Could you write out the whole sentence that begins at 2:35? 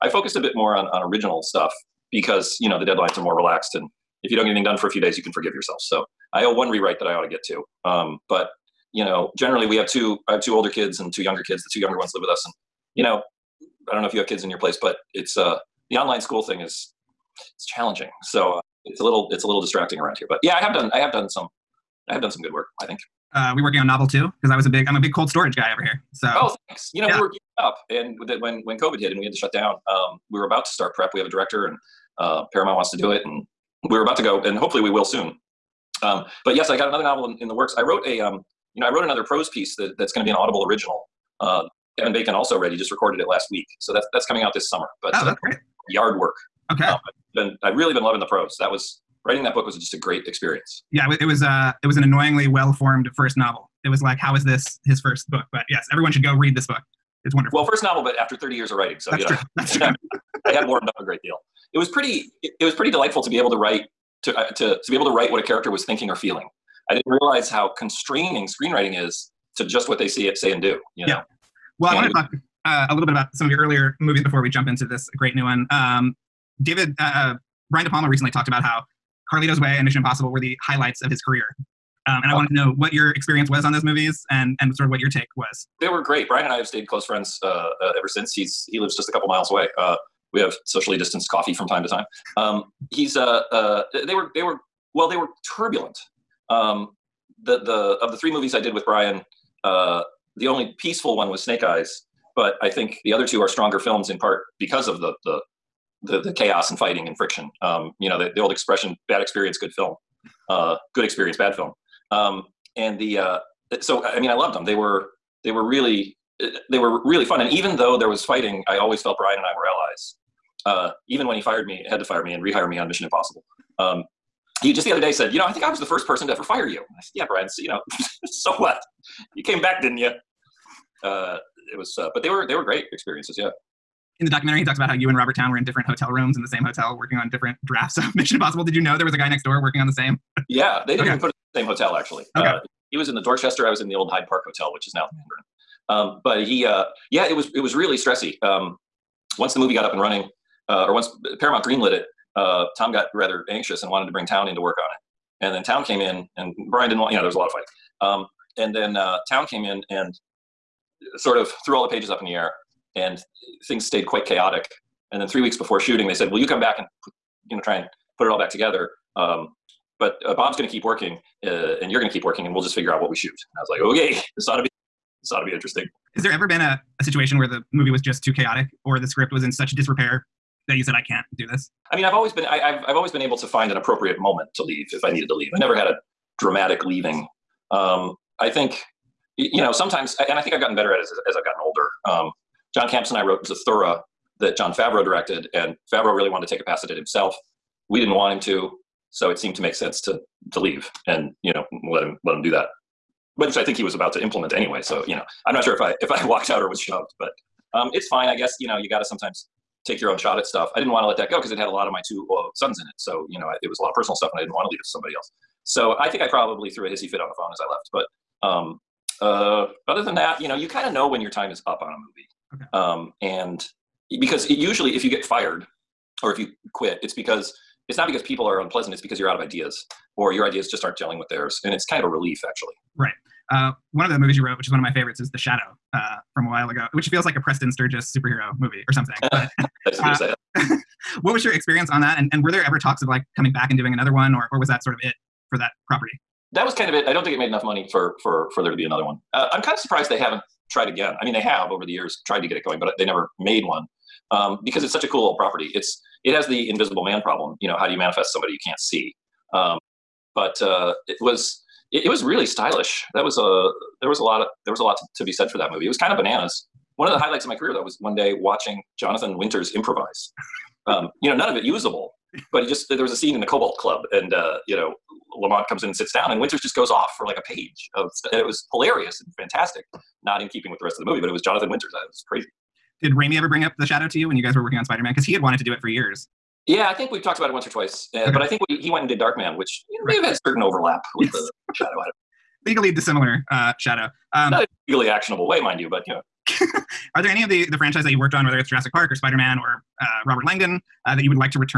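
And then Towne came in, and Brian didn't want.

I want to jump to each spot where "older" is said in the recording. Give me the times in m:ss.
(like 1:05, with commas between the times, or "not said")
0:10, 3:11.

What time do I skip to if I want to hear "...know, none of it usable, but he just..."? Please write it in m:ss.
4:31.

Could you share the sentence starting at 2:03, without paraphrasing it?
Um, he just the other day said, you know, I think I was the first person to ever fire you.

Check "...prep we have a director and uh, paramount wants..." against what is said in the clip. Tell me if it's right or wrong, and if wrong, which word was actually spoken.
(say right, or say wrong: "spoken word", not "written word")
right.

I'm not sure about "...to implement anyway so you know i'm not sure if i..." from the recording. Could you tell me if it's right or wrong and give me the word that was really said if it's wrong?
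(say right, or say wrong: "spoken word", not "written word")
right.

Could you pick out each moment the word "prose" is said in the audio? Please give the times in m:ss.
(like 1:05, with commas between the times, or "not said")
0:39, 0:48.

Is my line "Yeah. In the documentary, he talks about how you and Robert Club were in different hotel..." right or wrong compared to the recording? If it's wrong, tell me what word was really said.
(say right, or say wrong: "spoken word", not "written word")
wrong: "Towne", not "Club".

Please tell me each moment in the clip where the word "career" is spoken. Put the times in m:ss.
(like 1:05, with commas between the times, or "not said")
1:21, 4:27.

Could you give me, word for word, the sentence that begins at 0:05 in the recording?
So I owe one rewrite that I ought to get to.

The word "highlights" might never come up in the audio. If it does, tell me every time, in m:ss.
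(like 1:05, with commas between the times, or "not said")
1:20, 4:27.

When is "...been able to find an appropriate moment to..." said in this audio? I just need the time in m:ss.
3:03.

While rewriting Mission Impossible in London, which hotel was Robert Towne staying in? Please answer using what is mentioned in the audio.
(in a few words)
The Dorchester.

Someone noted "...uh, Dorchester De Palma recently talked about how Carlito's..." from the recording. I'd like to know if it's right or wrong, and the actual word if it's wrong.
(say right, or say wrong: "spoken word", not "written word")
wrong: "Brian", not "Dorchester".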